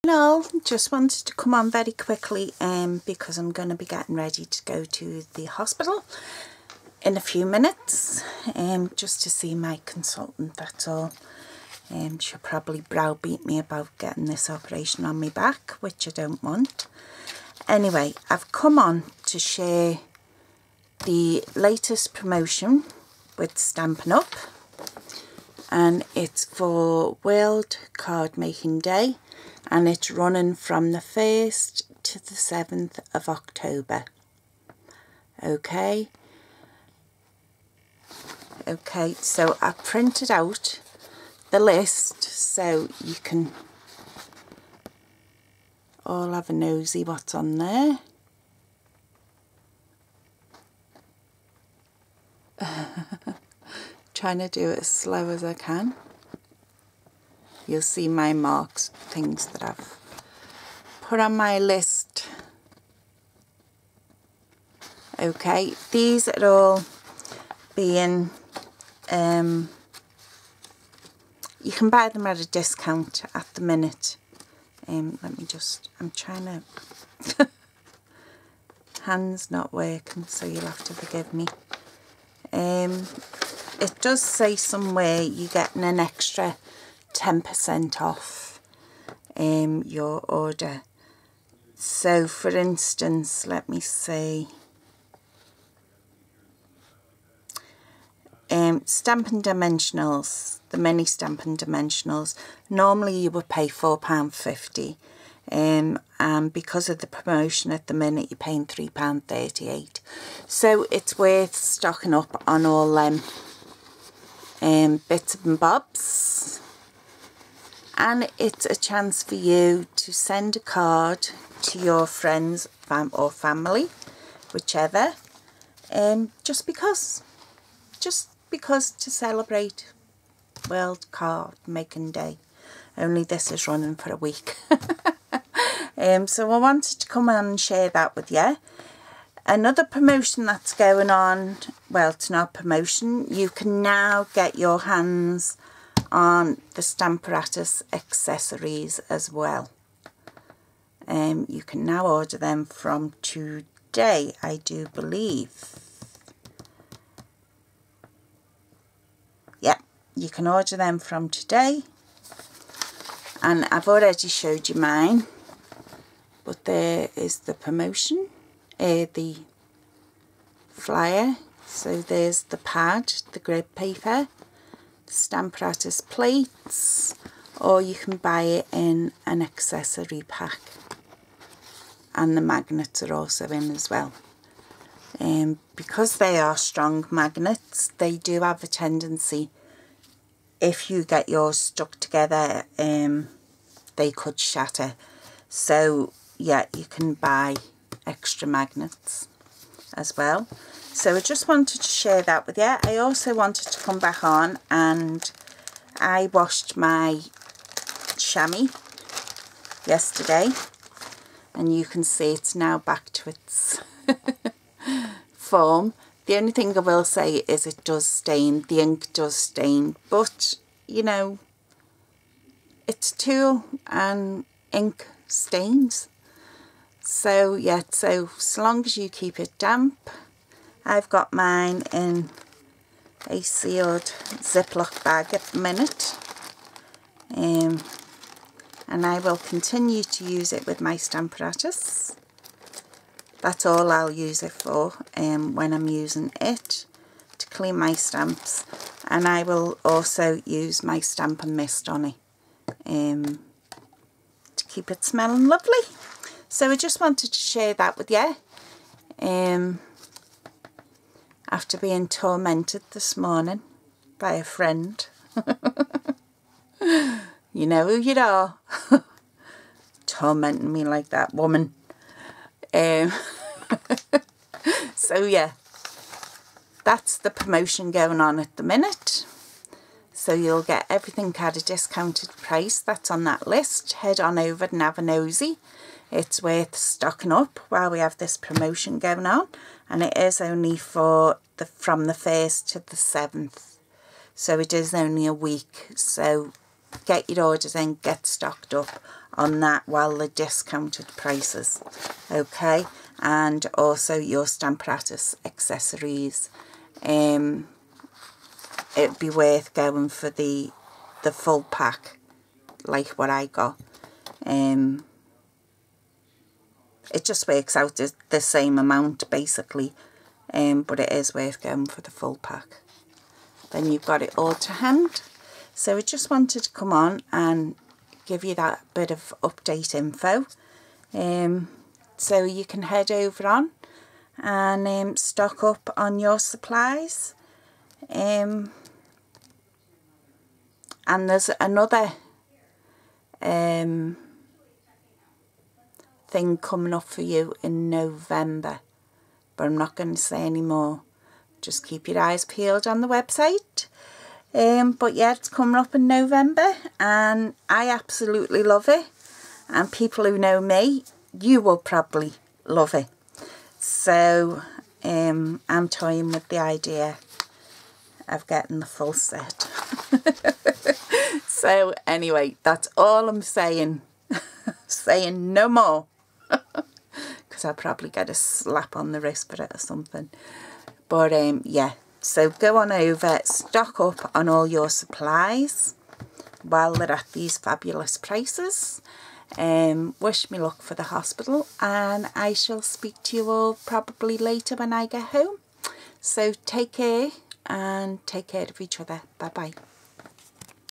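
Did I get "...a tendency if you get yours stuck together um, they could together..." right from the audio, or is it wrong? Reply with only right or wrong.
wrong.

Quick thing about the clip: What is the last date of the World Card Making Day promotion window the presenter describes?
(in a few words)
7th of October.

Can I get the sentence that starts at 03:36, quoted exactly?
The only thing I will say is it does stain, the ink does stain, but you know, it's tool and ink stains.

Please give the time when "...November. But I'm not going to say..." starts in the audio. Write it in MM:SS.
05:47.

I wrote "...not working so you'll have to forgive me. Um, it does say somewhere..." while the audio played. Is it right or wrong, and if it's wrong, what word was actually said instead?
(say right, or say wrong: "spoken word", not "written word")
right.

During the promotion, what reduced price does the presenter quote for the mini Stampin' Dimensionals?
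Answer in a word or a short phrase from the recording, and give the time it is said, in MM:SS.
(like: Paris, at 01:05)
£3.38, at 01:48.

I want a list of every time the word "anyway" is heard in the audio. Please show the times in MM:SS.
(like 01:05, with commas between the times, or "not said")
00:17, 06:12.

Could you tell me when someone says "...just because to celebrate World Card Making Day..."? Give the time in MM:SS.
02:07.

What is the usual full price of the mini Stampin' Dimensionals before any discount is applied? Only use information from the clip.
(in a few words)
£4.50.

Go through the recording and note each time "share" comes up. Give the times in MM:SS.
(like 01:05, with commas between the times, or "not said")
00:19, 02:17, 03:21, 04:17.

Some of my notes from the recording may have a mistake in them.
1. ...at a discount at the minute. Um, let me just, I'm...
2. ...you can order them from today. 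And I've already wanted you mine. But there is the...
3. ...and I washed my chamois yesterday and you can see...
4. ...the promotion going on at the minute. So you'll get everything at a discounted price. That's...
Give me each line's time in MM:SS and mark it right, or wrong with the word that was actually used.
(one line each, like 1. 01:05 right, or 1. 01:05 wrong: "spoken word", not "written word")
1. 01:12 right
2. 02:40 wrong: "showed", not "wanted"
3. 03:24 right
4. 04:37 right.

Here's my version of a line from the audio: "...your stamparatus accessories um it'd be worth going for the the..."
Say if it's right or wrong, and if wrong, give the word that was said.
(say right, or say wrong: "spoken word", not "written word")
right.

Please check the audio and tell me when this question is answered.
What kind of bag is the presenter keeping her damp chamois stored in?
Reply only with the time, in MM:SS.
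03:54.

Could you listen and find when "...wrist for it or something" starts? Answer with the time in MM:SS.
06:19.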